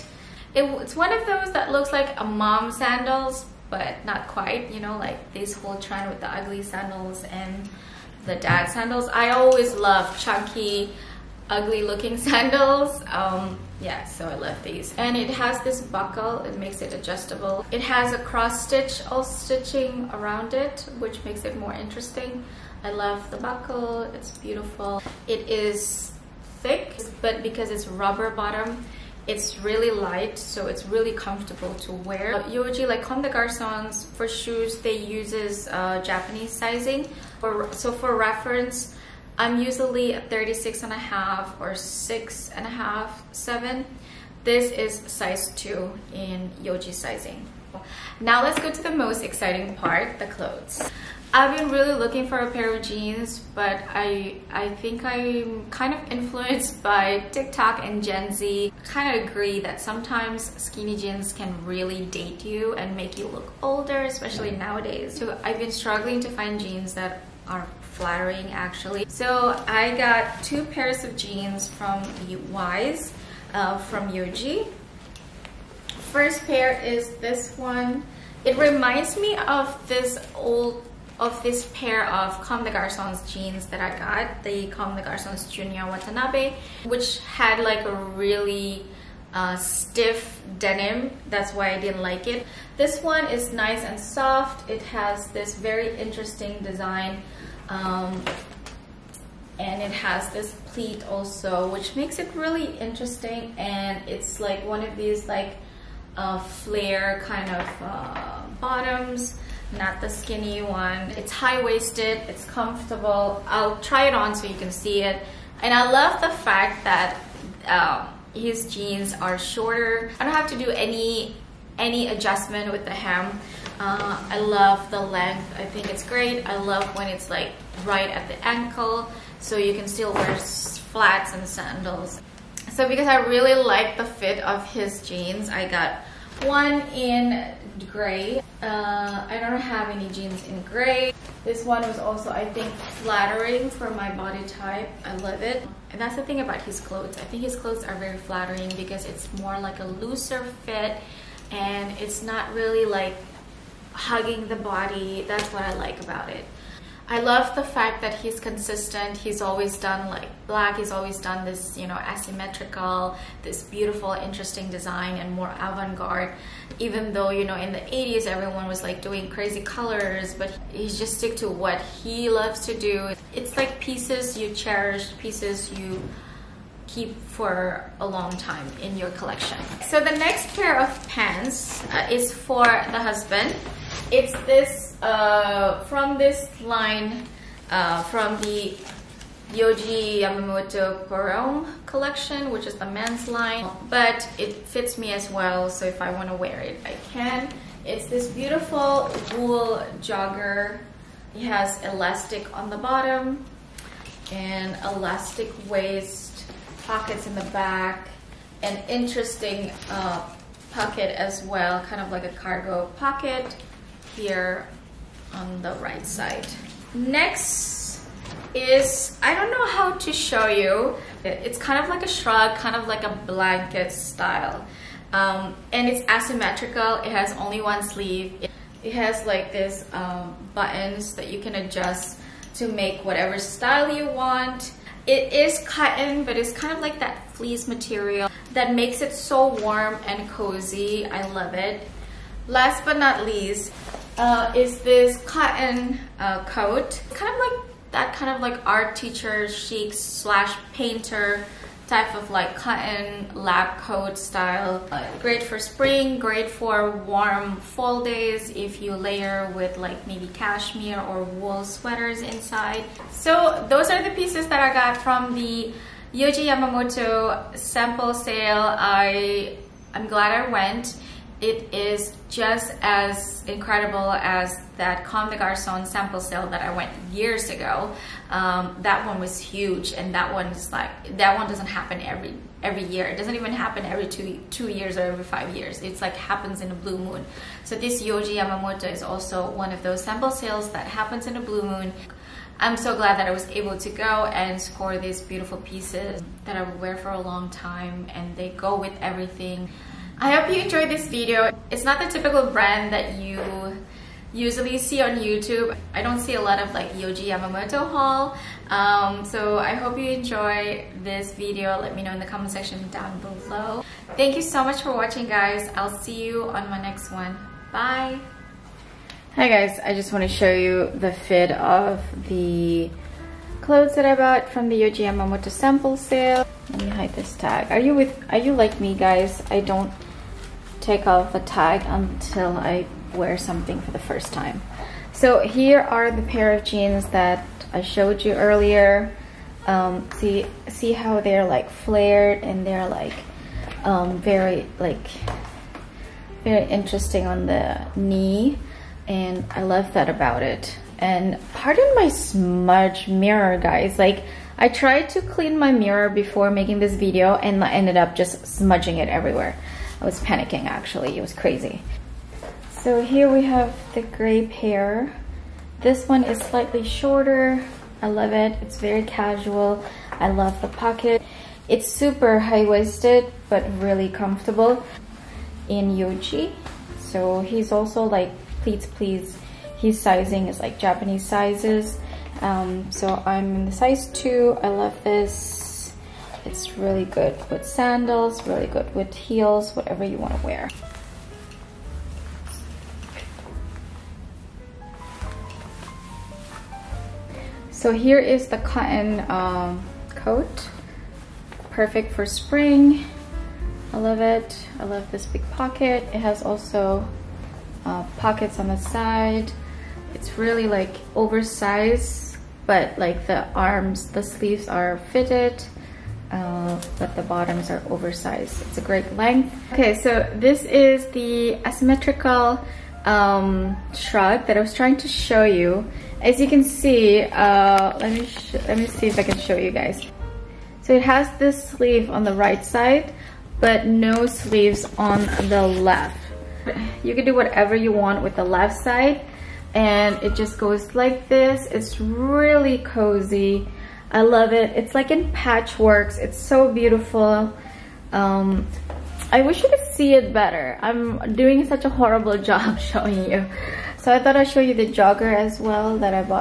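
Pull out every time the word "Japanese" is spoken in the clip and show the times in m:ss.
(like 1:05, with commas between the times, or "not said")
0:36, 6:20.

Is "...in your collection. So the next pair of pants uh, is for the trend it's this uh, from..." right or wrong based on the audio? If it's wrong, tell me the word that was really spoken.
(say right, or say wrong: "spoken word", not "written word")
wrong: "husband", not "trend".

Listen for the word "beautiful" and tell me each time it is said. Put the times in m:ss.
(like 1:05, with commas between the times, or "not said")
0:24, 2:43, 3:18, 4:55, 7:26.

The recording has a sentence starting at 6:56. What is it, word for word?
Uh, but the bottoms are oversized.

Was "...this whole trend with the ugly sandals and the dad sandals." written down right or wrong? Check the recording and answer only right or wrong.
right.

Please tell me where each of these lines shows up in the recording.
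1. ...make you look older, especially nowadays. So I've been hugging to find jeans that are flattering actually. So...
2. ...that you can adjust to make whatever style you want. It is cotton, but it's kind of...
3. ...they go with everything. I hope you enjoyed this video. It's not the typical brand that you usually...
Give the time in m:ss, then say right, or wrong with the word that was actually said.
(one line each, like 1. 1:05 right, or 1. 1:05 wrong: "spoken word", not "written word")
1. 1:02 wrong: "struggling", not "hugging"
2. 3:51 right
3. 4:58 right.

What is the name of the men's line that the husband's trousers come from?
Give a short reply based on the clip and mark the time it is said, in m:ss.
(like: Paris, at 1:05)
Yohji Yamamoto Pour Homme, at 3:09.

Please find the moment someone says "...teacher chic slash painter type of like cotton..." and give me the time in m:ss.
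4:08.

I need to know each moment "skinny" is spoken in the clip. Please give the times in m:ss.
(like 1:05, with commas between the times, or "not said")
1:00, 1:50.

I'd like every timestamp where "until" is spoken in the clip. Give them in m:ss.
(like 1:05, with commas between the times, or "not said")
5:31.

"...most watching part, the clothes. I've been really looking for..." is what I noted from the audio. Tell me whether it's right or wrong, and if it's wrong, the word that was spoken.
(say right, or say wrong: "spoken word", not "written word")
wrong: "exciting", not "watching".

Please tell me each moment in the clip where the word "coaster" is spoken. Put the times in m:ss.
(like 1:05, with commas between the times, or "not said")
not said.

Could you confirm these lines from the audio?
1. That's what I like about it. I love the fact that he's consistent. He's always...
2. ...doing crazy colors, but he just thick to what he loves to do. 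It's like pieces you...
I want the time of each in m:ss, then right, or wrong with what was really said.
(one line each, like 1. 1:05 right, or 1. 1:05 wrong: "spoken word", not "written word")
1. 2:35 right
2. 2:49 wrong: "stick", not "thick".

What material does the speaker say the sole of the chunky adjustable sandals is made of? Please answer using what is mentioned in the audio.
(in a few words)
rubber.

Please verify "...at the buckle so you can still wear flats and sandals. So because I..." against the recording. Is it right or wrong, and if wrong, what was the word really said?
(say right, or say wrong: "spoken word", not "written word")
wrong: "ankle", not "buckle".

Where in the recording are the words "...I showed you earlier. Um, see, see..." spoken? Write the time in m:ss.
5:37.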